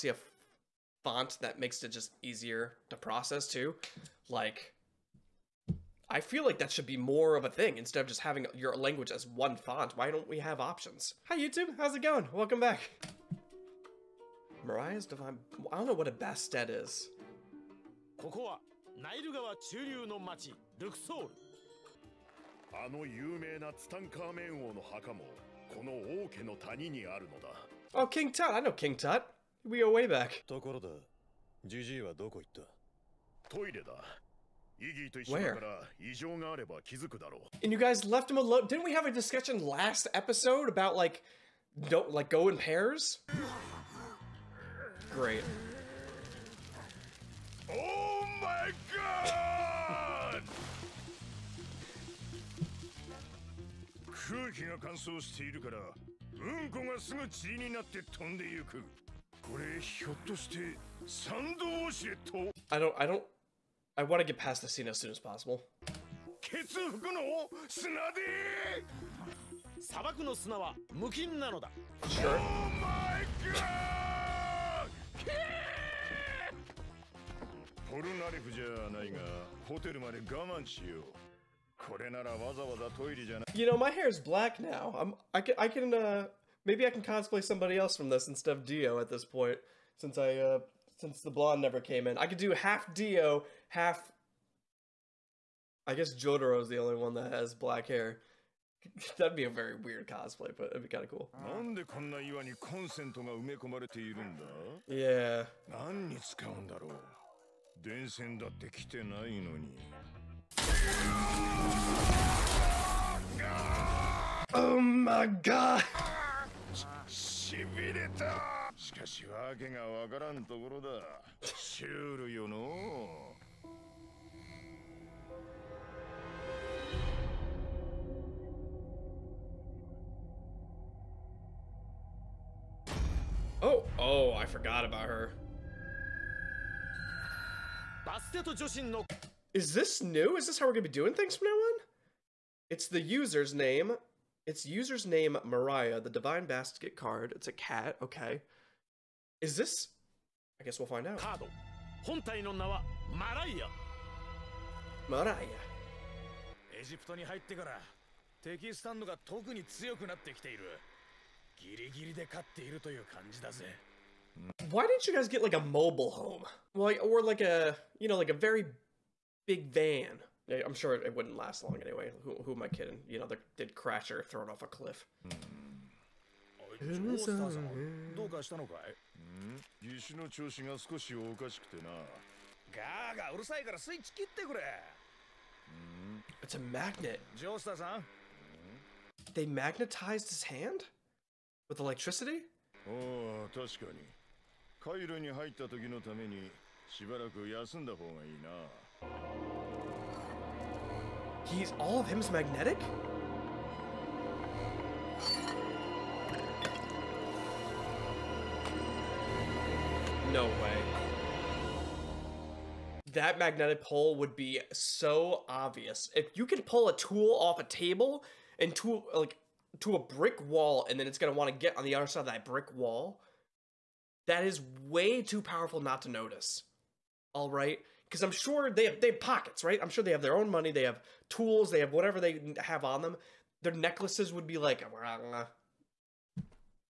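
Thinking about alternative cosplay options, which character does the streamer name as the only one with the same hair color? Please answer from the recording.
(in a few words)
Jotaro.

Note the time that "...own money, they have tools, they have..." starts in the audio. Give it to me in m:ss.
3:50.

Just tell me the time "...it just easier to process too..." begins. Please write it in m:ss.
0:01.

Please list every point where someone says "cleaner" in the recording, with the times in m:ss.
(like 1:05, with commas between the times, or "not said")
not said.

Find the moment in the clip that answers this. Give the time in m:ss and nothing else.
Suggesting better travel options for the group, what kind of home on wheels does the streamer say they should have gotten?
2:45.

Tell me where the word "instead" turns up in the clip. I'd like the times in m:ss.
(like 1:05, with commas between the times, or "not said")
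0:07, 1:28.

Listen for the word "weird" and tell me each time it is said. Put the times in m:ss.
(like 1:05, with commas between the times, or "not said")
1:39.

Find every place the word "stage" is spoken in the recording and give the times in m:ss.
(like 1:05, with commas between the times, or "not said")
not said.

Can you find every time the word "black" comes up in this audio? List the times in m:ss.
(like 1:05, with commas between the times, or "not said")
1:24, 1:37.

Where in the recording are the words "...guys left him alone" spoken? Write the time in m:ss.
0:37.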